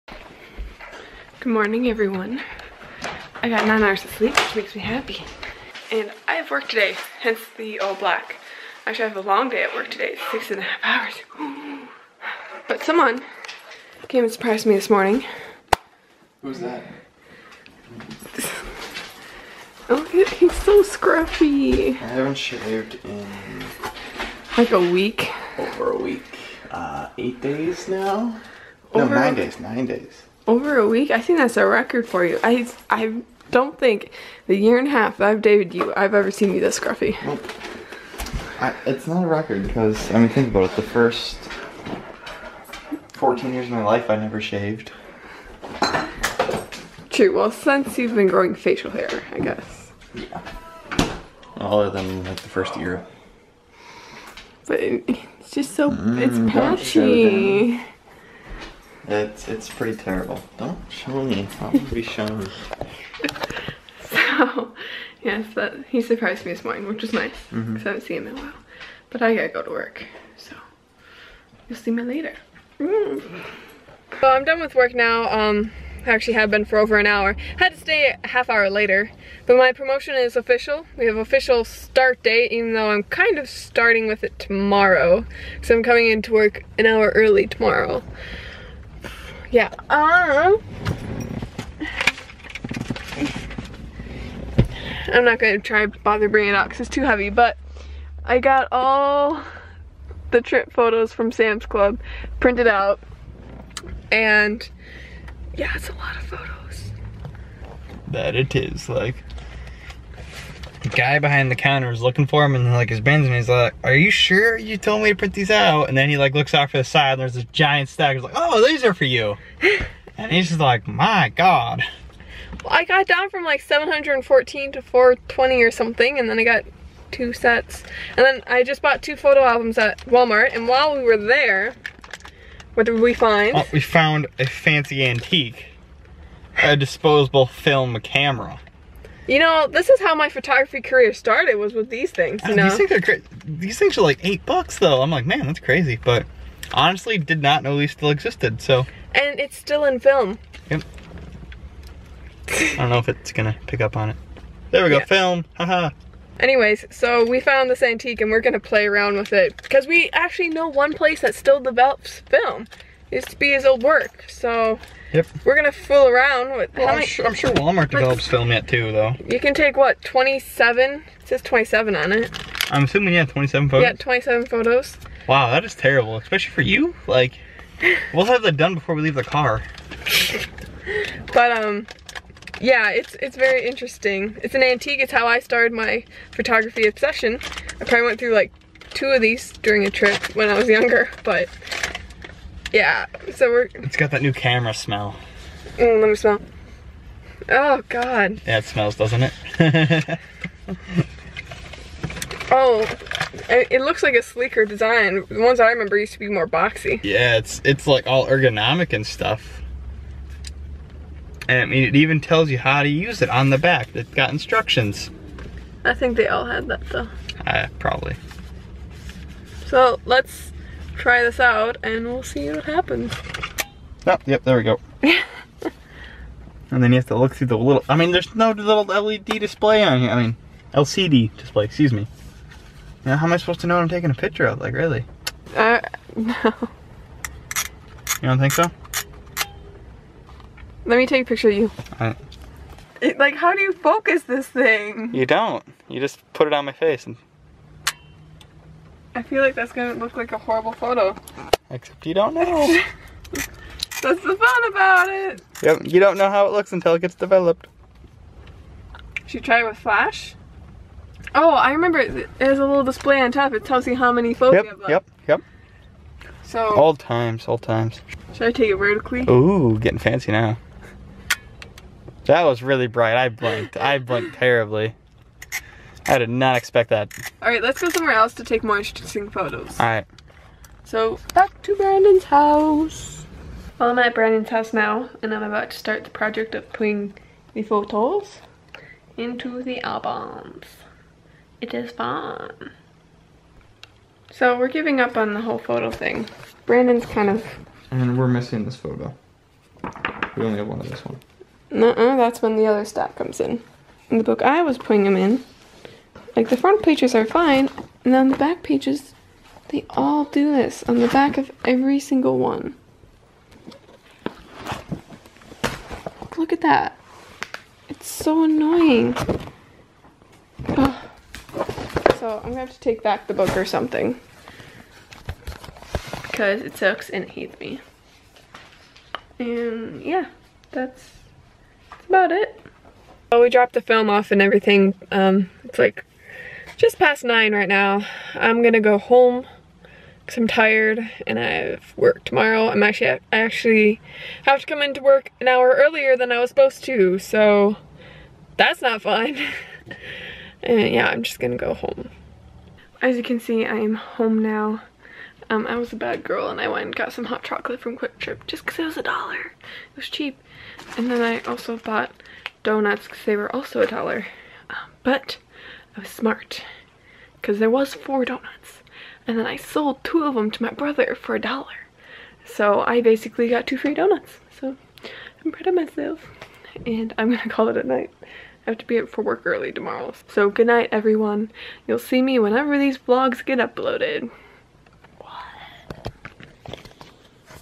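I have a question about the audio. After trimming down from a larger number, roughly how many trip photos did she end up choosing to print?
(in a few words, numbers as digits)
420.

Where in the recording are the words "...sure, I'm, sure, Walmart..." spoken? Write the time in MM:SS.
02:47.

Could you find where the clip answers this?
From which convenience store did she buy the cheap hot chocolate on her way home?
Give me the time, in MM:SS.
05:57.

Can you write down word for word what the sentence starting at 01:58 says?
He's like, oh, these are for you.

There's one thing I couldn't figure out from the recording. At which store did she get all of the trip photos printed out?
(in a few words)
Sam's Club.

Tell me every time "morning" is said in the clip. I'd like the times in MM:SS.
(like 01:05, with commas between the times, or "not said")
00:01, 00:14, 01:06.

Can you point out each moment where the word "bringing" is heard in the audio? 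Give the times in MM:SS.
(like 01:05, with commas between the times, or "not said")
01:36.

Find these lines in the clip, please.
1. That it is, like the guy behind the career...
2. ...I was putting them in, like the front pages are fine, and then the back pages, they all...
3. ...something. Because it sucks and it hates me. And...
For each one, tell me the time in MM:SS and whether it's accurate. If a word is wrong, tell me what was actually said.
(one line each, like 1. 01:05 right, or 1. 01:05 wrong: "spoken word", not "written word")
1. 01:48 wrong: "counter", not "career"
2. 05:04 right
3. 05:23 right.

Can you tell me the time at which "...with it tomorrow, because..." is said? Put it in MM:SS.
01:24.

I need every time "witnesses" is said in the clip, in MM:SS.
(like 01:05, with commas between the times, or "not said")
not said.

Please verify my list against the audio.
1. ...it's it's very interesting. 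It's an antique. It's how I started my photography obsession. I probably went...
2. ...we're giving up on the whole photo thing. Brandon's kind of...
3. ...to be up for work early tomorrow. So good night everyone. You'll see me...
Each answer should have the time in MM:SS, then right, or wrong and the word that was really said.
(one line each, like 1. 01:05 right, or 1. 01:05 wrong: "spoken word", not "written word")
1. 03:02 right
2. 04:54 right
3. 06:18 right.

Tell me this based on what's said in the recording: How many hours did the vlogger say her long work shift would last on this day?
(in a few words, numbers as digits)
6.5 hours.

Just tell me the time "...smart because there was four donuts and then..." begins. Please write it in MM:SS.
06:06.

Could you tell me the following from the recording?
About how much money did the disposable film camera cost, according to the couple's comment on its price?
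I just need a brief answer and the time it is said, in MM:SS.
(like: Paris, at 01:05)
8 dollars, at 02:24.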